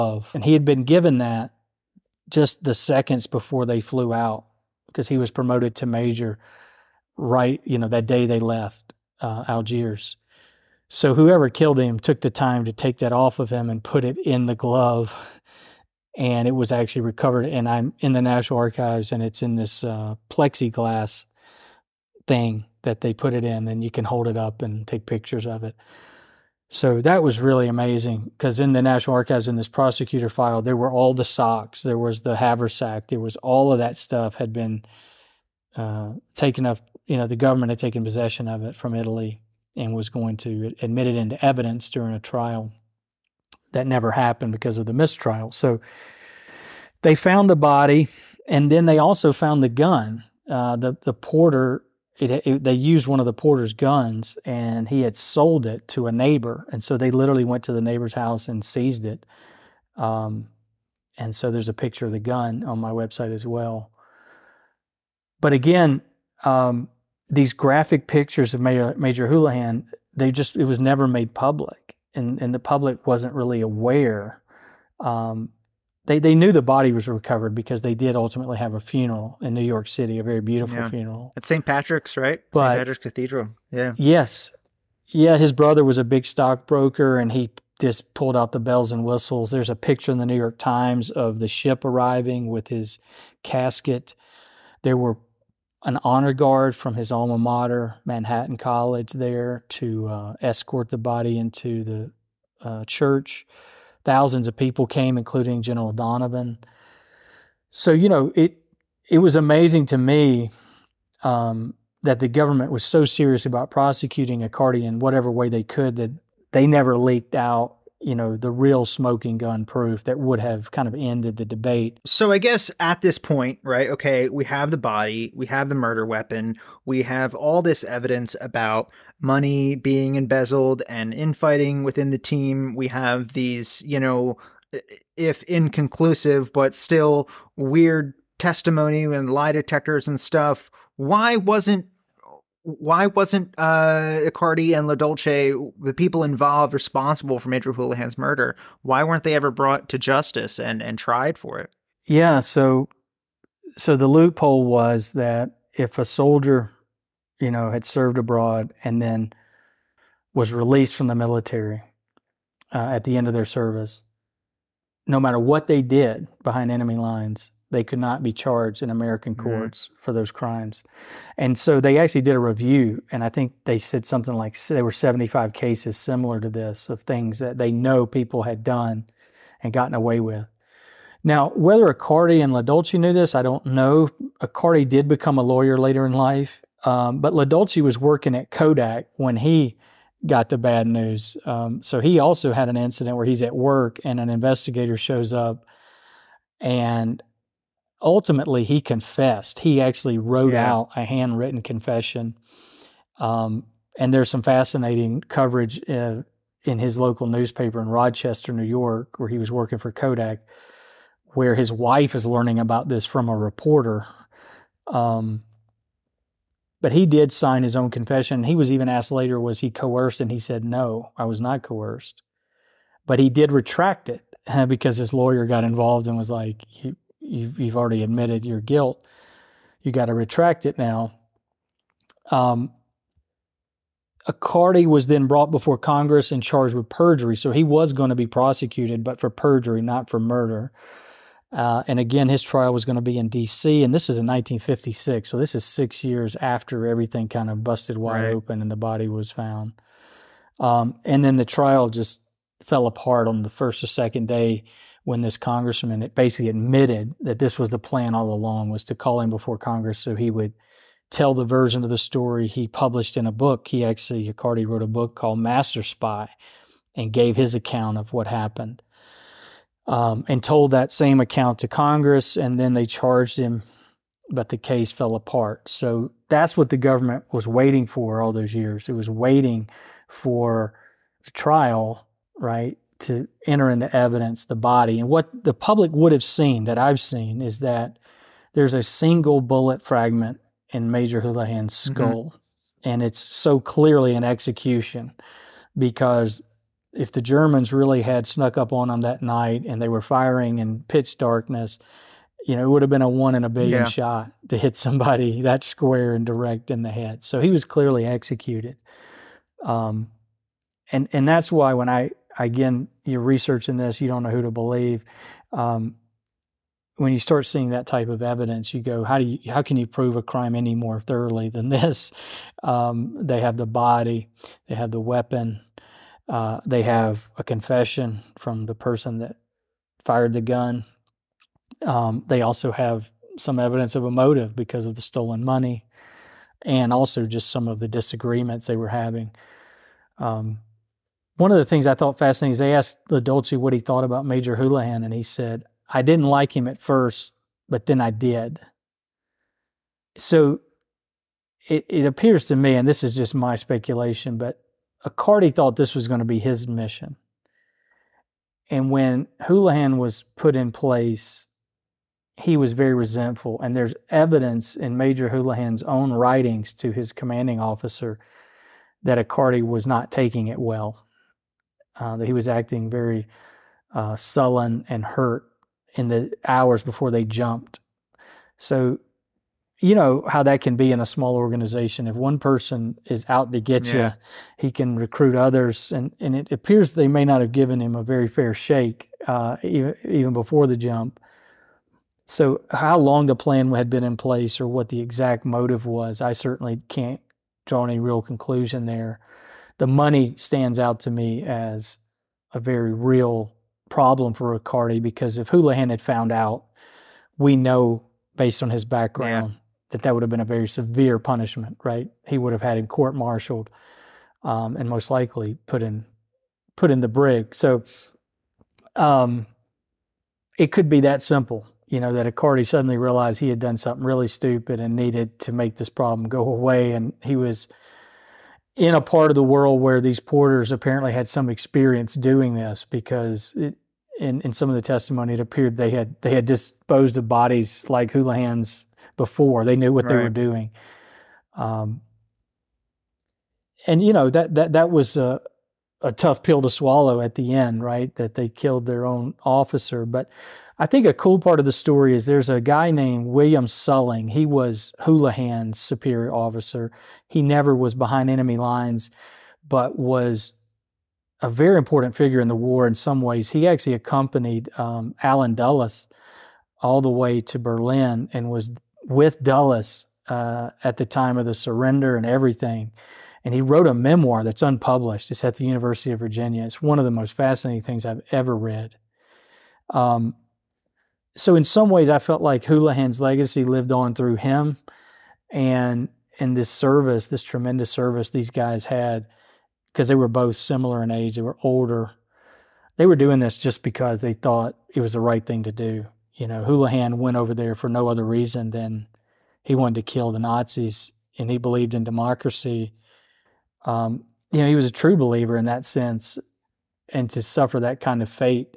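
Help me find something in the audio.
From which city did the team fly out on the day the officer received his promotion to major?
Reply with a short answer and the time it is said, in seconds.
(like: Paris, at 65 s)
Algiers, at 9 s.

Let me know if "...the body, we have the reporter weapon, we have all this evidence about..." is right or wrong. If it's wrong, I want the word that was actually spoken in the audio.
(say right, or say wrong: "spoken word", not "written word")
wrong: "murder", not "reporter".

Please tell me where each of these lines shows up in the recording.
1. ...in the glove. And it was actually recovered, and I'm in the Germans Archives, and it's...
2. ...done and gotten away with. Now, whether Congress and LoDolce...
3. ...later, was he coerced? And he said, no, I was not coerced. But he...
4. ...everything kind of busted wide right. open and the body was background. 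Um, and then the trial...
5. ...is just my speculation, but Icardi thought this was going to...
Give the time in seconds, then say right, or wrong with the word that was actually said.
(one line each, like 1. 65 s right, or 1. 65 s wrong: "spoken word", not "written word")
1. 14 s wrong: "National", not "Germans"
2. 178 s wrong: "Icardi", not "Congress"
3. 219 s right
4. 246 s wrong: "found", not "background"
5. 353 s right.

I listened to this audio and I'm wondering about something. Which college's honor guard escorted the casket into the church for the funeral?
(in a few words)
Manhattan College.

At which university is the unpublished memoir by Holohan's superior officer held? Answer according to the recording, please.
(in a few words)
University of Virginia.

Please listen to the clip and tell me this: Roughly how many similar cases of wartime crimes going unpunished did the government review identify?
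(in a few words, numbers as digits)
75.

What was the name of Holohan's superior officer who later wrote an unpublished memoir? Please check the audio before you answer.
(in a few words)
William Suhling.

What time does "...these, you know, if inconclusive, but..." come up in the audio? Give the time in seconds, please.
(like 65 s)
133 s.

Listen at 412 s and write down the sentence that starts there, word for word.
He would have had him court-martialed um, and most likely put in put in the brig.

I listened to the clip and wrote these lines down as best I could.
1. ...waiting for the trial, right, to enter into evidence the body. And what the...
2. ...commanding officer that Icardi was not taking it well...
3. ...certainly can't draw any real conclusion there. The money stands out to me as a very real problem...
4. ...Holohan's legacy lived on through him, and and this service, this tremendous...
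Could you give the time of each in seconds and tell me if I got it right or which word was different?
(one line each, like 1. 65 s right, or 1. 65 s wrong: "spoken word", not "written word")
1. 279 s right
2. 367 s right
3. 396 s right
4. 482 s right.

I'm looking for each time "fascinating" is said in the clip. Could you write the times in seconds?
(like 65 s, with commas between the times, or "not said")
204 s, 342 s, 477 s.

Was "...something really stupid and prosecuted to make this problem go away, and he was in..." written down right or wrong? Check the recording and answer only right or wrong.
wrong.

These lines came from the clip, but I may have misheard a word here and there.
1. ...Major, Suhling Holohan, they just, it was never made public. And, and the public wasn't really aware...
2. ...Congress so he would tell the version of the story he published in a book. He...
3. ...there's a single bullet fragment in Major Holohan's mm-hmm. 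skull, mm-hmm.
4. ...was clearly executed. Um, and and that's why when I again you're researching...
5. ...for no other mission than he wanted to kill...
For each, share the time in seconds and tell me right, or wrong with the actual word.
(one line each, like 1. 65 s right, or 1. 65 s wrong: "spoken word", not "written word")
1. 68 s wrong: "Major", not "Suhling"
2. 259 s right
3. 288 s right
4. 307 s right
5. 497 s wrong: "reason", not "mission".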